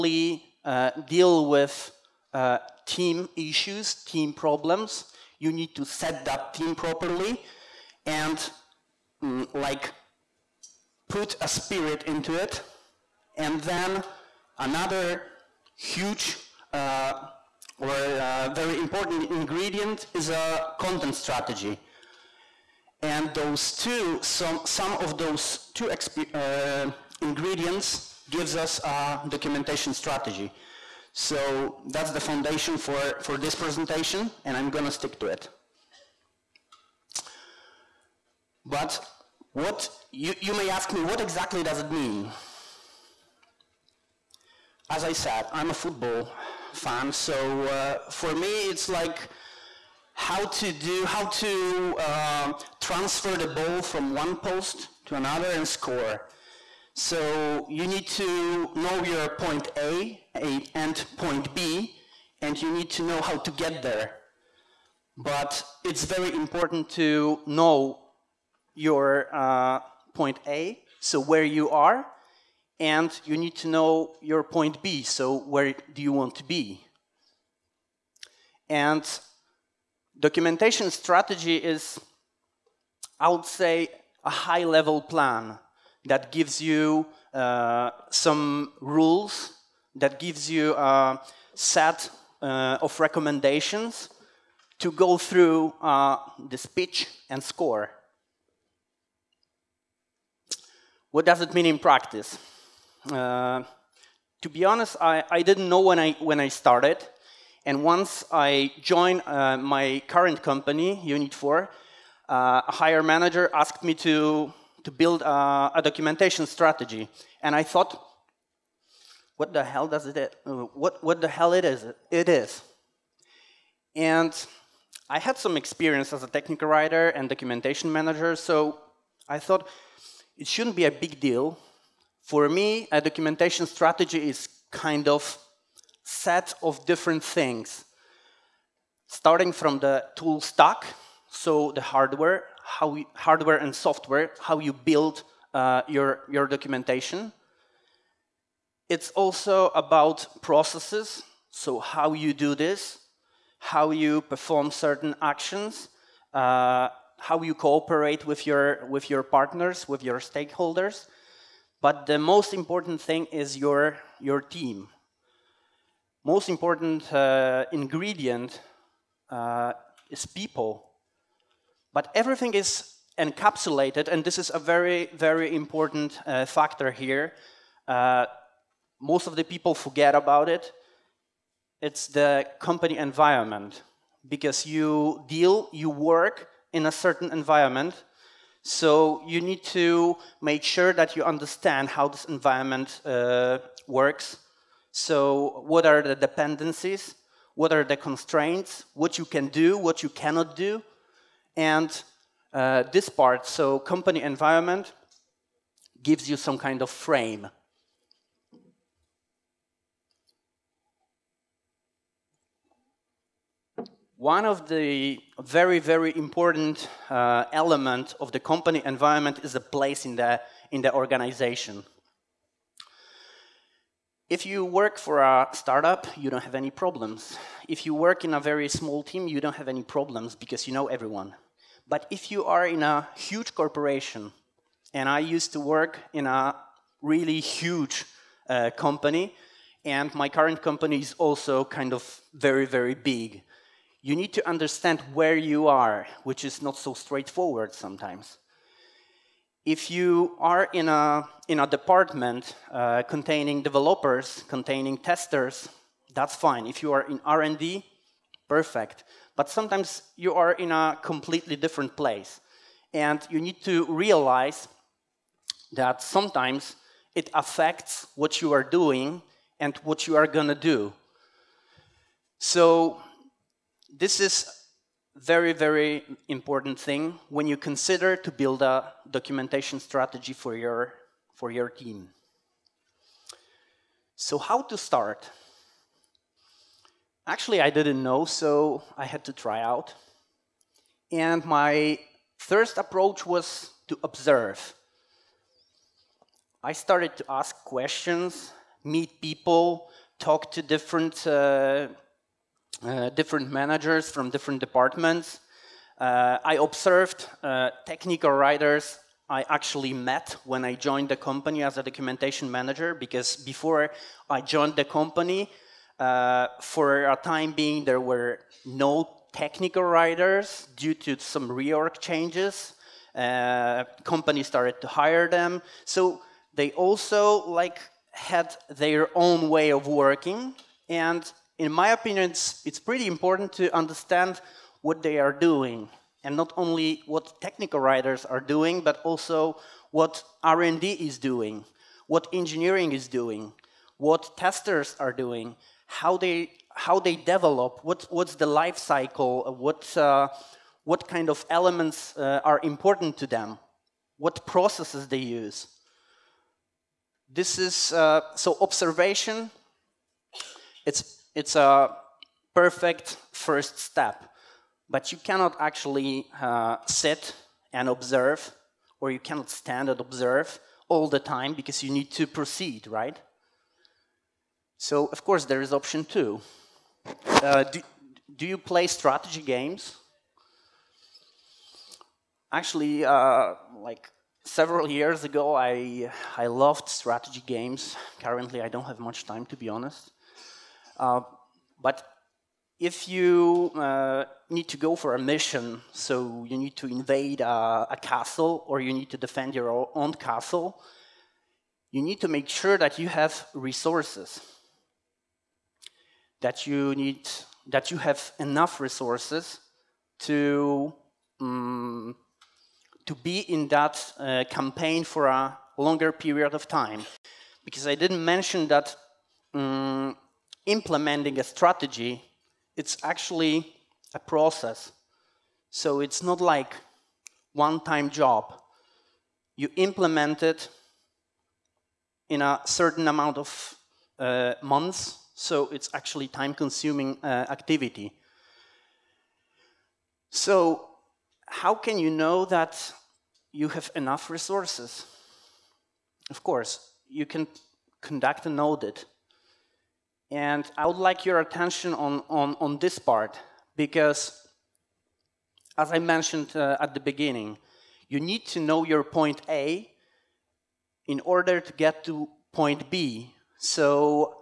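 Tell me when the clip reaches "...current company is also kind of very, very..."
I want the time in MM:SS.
04:00.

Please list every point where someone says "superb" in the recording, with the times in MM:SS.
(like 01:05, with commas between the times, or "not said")
not said.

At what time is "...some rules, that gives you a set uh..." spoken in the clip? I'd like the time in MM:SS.
01:28.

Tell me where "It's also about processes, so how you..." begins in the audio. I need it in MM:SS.
02:28.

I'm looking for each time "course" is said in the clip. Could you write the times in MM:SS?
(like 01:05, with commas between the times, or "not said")
06:15, 07:26.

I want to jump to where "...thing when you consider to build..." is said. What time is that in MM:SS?
04:36.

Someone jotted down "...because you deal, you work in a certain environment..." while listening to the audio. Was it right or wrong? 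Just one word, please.
right.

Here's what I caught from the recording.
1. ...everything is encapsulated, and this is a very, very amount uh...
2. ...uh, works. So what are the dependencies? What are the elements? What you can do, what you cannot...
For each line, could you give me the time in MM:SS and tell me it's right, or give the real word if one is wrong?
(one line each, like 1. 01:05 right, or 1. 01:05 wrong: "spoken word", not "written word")
1. 02:52 wrong: "important", not "amount"
2. 03:13 wrong: "constraints", not "elements".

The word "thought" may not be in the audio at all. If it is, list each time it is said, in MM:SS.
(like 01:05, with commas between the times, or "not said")
01:57, 02:09.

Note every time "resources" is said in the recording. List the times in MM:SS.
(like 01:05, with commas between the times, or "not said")
06:43, 06:48, 07:24.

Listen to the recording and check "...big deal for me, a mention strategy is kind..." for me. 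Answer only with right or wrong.
wrong.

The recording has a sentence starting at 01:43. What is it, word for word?
Uh, to be honest, I, I didn't know when I, when I started.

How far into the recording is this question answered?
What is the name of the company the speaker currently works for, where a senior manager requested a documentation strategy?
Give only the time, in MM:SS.
01:51.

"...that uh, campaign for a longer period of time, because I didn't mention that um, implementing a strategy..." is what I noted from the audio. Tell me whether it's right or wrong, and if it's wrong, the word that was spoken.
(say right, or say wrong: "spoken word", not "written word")
right.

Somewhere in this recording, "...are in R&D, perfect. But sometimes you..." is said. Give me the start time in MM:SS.
04:16.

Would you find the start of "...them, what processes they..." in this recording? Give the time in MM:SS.
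05:53.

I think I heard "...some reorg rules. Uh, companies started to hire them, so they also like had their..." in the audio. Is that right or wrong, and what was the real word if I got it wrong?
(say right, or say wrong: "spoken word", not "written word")
wrong: "changes", not "rules".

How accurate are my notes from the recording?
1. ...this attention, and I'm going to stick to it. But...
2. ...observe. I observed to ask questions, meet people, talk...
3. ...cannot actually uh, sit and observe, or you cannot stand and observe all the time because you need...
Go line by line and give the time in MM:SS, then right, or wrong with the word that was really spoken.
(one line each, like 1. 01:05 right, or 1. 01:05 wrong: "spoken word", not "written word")
1. 00:33 wrong: "presentation", not "attention"
2. 04:54 wrong: "started", not "observed"
3. 06:05 right.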